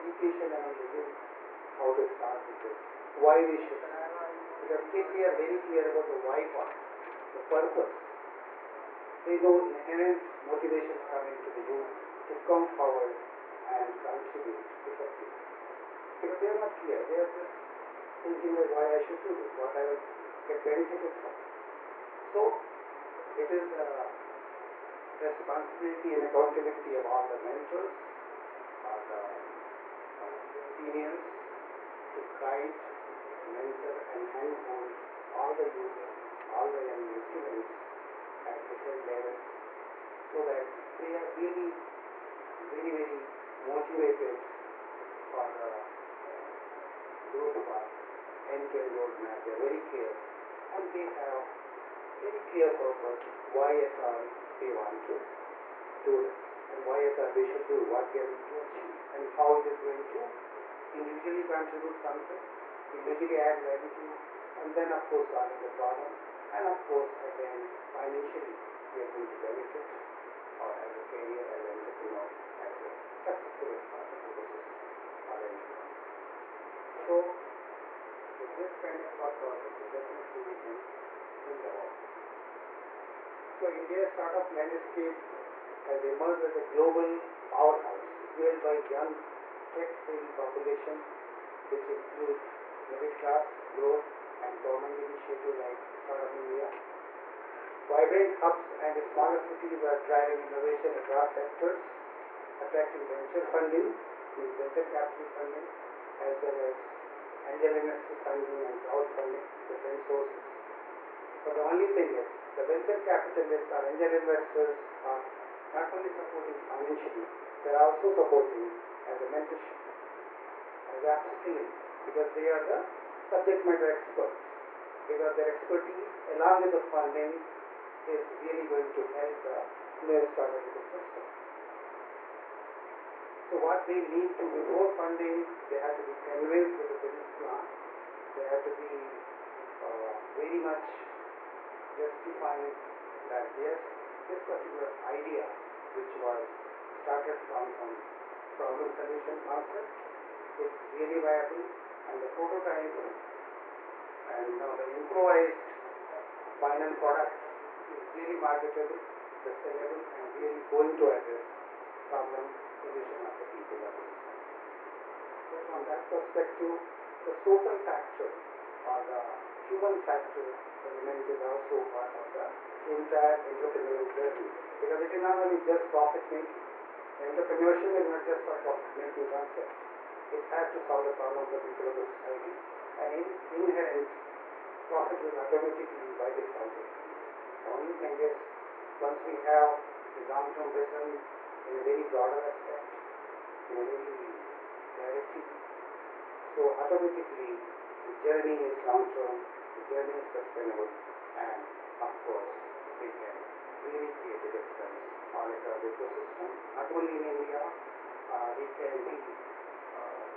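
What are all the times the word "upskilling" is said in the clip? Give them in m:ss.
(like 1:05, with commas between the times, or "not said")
2:01.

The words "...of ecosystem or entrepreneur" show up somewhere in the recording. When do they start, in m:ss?
1:14.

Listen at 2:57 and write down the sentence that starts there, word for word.
Entrepreneurship is not just a profit making concept.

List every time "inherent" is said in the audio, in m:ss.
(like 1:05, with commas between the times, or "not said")
0:09, 3:03.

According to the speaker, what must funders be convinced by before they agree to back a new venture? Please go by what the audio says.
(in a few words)
The business plan.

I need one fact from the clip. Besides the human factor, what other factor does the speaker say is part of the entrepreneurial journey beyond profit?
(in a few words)
Social factor.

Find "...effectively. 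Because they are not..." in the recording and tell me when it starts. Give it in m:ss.
0:14.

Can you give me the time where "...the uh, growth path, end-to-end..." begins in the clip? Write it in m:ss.
0:45.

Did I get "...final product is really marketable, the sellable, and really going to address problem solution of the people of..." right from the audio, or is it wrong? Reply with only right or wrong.
right.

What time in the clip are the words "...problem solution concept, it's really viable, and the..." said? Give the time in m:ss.
2:28.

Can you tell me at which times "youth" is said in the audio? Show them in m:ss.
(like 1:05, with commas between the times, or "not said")
0:00, 0:11, 0:35.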